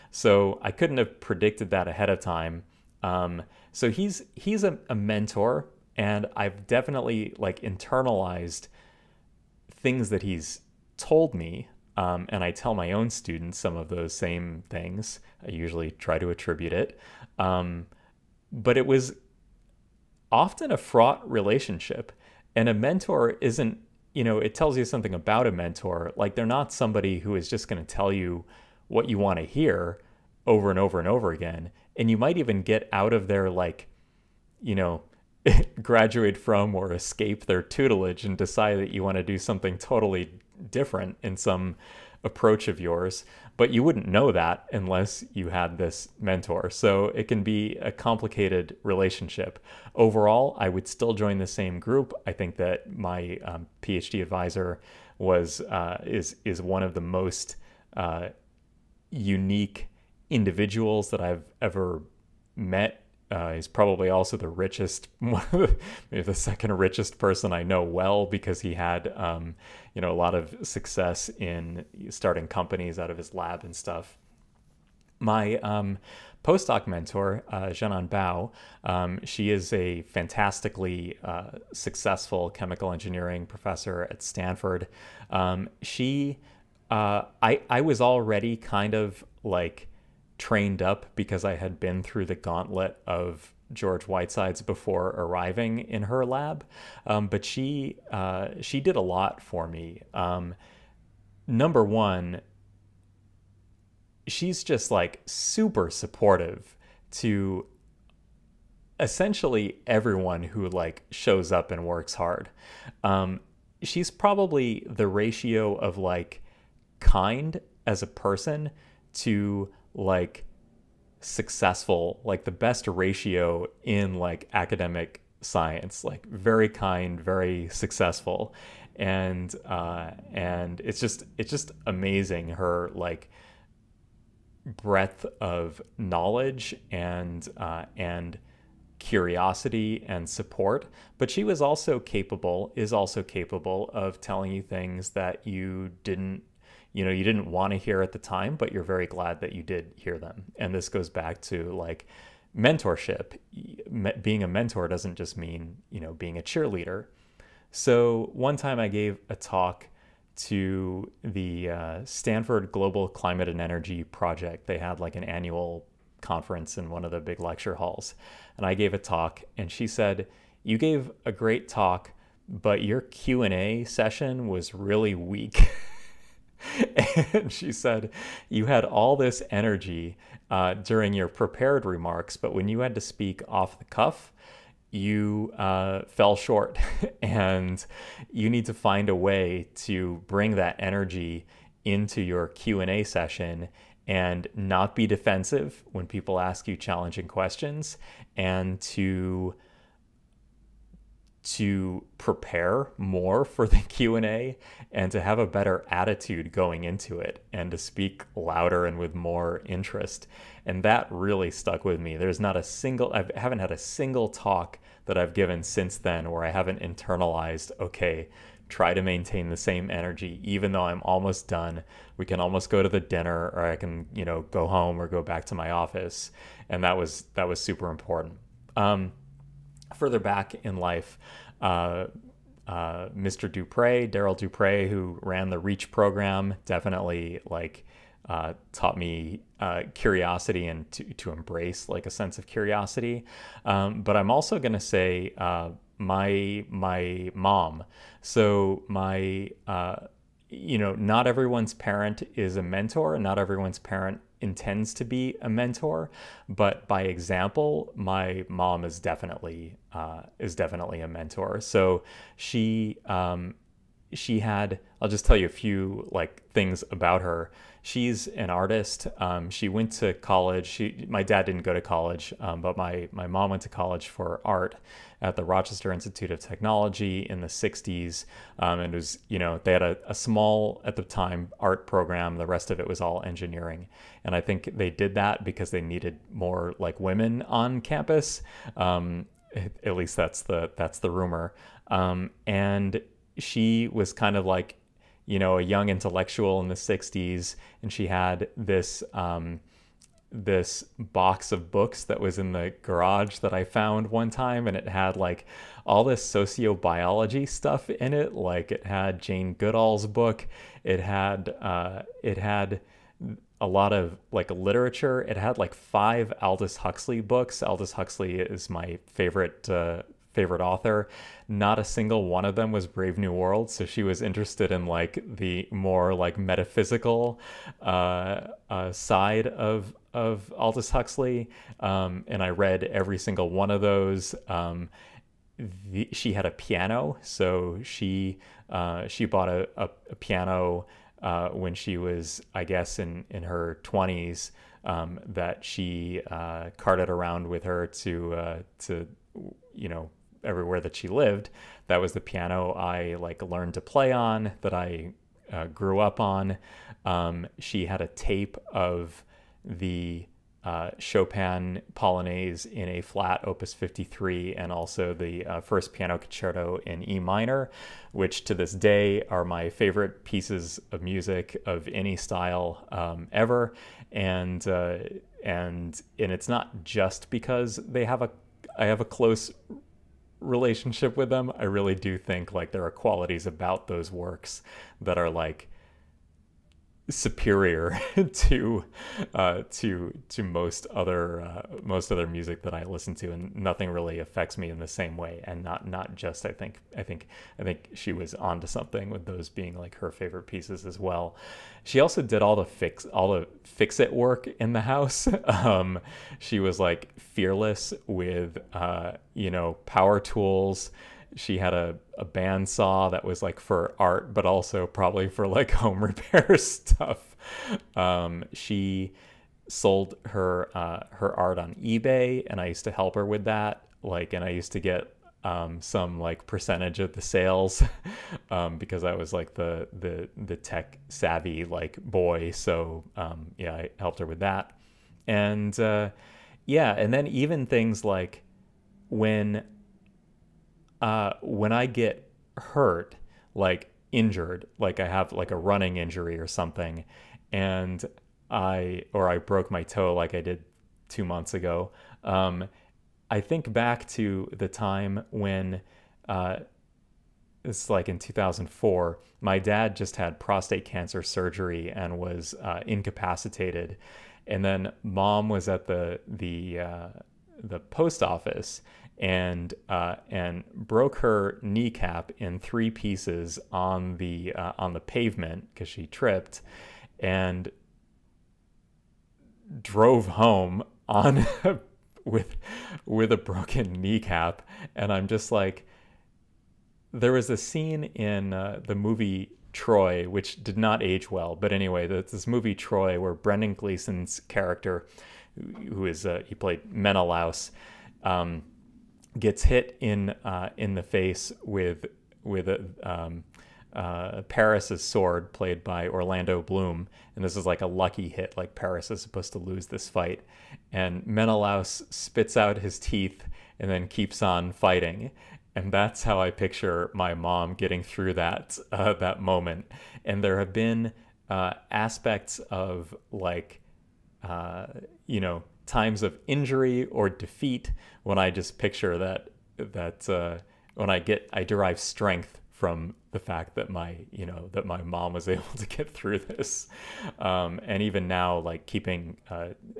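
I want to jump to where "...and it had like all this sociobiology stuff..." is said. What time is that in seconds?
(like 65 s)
304 s.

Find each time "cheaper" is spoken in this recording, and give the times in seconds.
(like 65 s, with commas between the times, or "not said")
not said.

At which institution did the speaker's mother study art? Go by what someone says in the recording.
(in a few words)
Rochester Institute of Technology.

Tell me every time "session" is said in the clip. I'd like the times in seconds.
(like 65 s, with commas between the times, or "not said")
173 s, 193 s.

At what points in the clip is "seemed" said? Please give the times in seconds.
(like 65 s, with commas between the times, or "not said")
not said.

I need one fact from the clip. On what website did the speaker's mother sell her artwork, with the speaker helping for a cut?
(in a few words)
eBay.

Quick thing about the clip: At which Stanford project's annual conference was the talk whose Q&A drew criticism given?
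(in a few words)
Global Climate and Energy Project.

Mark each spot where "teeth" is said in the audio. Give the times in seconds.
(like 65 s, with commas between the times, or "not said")
512 s.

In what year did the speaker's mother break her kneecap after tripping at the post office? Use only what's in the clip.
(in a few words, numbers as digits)
2004.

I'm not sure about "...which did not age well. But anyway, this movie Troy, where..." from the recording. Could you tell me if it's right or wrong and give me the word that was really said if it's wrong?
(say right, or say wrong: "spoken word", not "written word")
right.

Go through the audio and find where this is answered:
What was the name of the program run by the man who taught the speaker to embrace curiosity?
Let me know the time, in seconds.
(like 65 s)
235 s.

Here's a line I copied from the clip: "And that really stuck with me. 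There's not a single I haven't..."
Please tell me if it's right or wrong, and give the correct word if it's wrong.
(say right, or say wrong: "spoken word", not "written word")
right.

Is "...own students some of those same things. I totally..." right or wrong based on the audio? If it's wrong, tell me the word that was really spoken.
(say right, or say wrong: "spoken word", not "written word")
wrong: "usually", not "totally".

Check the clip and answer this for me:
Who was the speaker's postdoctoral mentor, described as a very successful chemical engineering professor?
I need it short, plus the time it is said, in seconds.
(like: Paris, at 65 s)
Zhenan Bao, at 77 s.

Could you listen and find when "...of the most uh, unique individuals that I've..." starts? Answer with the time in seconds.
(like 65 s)
56 s.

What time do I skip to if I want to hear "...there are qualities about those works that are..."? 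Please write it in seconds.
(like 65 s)
382 s.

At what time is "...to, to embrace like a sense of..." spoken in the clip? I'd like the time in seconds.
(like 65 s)
240 s.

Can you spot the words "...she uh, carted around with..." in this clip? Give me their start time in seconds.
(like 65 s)
345 s.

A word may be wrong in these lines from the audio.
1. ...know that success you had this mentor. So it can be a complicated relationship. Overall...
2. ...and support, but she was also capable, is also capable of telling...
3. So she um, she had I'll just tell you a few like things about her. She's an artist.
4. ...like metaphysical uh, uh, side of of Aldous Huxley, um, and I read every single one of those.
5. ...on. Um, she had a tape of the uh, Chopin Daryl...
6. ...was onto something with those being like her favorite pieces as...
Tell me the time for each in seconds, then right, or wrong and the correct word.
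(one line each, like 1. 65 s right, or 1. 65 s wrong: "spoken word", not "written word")
1. 44 s wrong: "unless", not "success"
2. 140 s right
3. 261 s right
4. 326 s right
5. 356 s wrong: "Polonaise", not "Daryl"
6. 398 s right.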